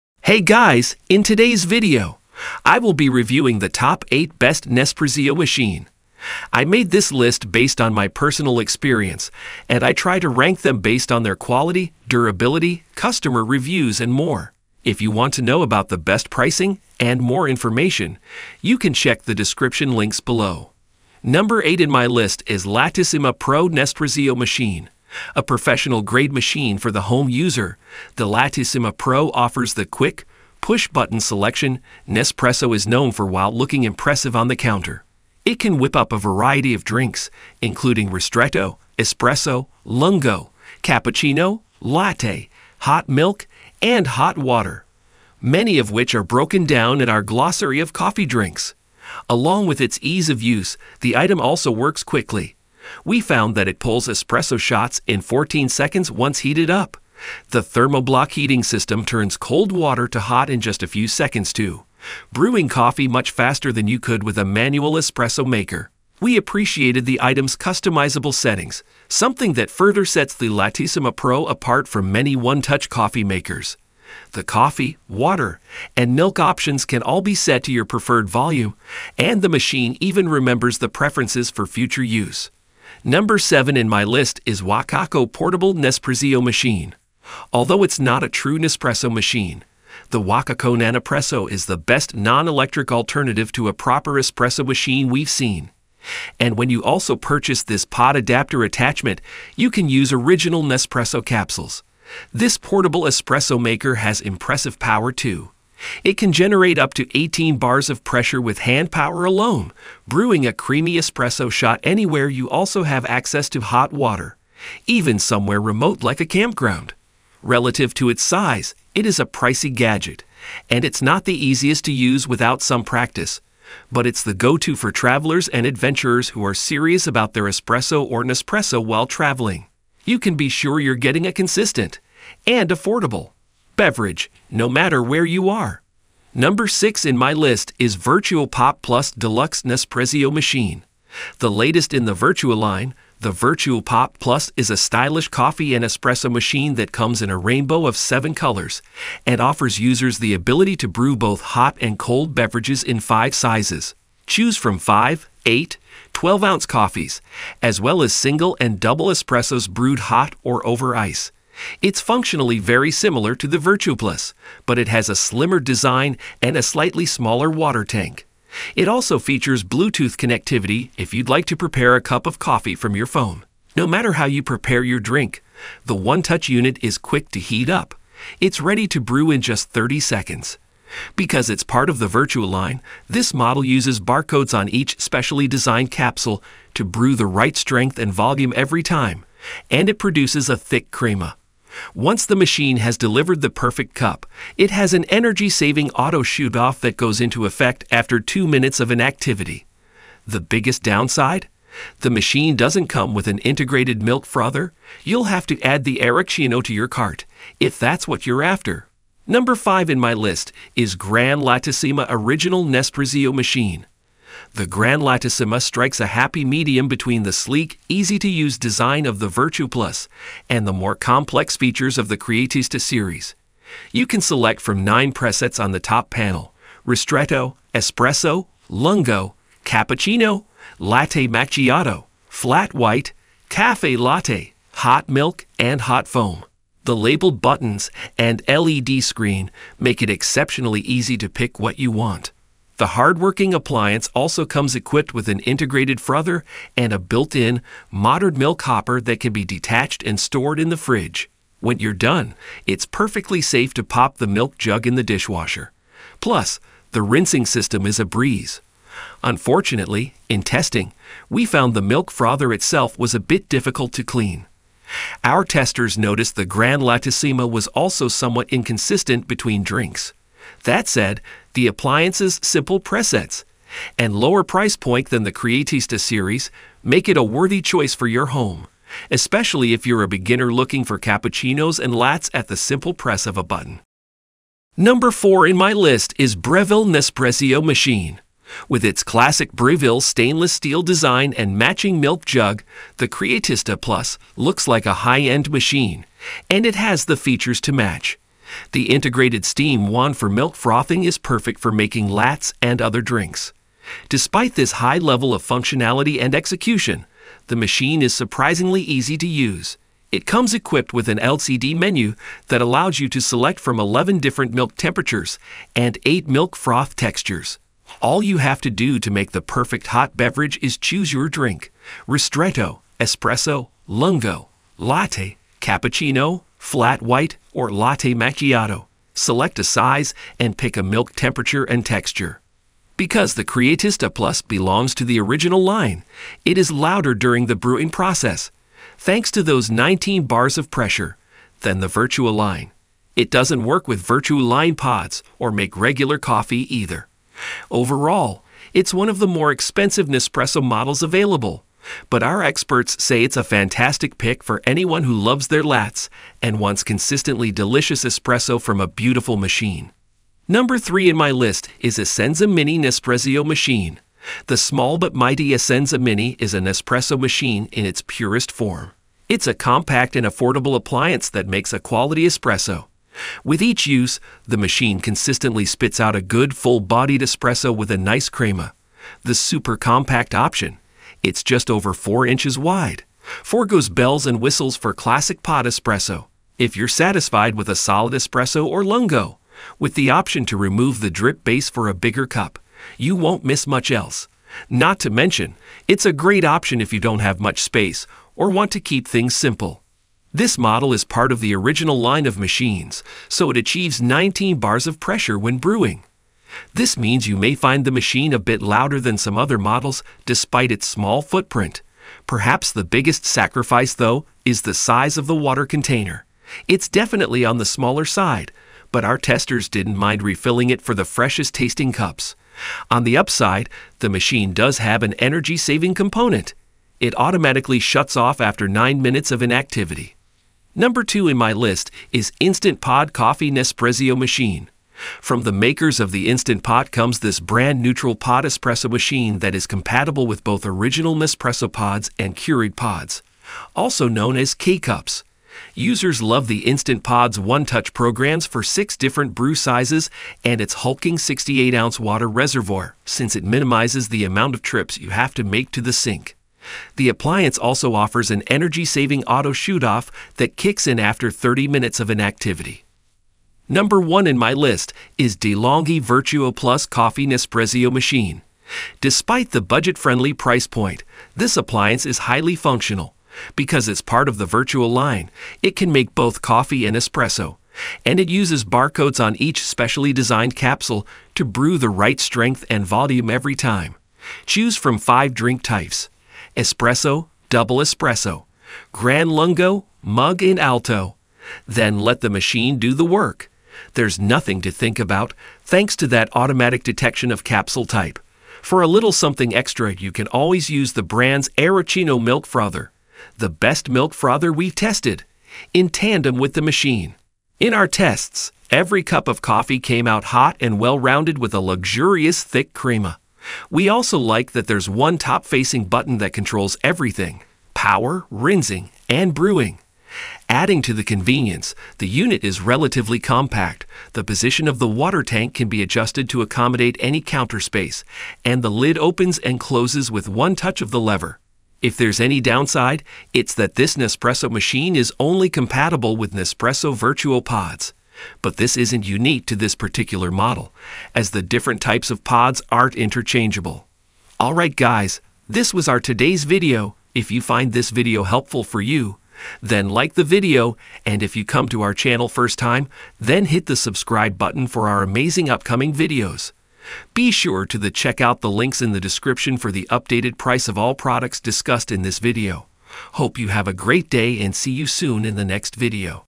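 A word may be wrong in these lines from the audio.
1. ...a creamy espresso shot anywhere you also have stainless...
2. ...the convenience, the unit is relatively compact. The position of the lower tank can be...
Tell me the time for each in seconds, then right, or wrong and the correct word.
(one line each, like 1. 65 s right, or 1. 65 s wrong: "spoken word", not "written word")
1. 110 s wrong: "access", not "stainless"
2. 520 s wrong: "water", not "lower".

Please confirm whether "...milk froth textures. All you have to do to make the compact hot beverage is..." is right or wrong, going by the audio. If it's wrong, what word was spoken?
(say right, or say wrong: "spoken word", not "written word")
wrong: "perfect", not "compact".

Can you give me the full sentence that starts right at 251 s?
When you're done, it's perfectly safe to pop the milk jug in the dishwasher.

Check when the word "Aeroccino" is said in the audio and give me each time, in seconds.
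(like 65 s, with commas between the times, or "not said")
206 s, 501 s.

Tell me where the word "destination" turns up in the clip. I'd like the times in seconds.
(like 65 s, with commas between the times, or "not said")
not said.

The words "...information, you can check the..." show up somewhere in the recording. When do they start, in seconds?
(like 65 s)
17 s.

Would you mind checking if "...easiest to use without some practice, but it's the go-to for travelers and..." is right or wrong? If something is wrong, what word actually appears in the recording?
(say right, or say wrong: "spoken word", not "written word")
right.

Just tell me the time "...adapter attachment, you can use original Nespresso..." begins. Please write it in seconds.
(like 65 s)
98 s.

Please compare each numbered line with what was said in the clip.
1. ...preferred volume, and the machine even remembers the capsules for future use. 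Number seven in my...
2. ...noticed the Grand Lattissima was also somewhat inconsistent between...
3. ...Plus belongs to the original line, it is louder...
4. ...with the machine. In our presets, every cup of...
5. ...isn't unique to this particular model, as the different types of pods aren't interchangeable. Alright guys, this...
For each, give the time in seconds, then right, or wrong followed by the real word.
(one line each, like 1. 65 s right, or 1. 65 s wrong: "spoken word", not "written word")
1. 77 s wrong: "preferences", not "capsules"
2. 265 s right
3. 334 s right
4. 506 s wrong: "tests", not "presets"
5. 538 s right.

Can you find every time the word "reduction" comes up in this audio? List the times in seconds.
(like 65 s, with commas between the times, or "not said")
not said.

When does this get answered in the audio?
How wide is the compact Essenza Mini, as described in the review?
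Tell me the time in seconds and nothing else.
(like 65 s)
381 s.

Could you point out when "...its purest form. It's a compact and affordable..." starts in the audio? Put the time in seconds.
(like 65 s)
367 s.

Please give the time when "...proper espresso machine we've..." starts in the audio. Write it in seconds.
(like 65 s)
93 s.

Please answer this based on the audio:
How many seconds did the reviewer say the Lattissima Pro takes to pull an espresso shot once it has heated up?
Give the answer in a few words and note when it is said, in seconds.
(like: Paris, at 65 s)
14 seconds, at 55 s.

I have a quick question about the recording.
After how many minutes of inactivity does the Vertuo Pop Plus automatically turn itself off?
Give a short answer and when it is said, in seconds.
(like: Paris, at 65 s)
2, at 198 s.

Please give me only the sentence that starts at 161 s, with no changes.
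It's functionally very similar to the Vertuo Plus, but it has a slimmer design and a slightly smaller water tank.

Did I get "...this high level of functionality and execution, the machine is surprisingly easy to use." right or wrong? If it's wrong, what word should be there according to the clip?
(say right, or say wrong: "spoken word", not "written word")
right.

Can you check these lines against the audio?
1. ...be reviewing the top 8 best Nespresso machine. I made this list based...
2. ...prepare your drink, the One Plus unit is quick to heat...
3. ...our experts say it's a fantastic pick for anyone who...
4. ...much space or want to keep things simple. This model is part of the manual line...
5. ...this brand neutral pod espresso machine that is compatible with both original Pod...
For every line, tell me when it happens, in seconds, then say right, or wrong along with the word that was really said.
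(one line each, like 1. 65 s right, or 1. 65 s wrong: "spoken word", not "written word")
1. 2 s right
2. 174 s wrong: "Touch", not "Plus"
3. 352 s right
4. 397 s wrong: "original", not "manual"
5. 437 s wrong: "Nespresso", not "Pod".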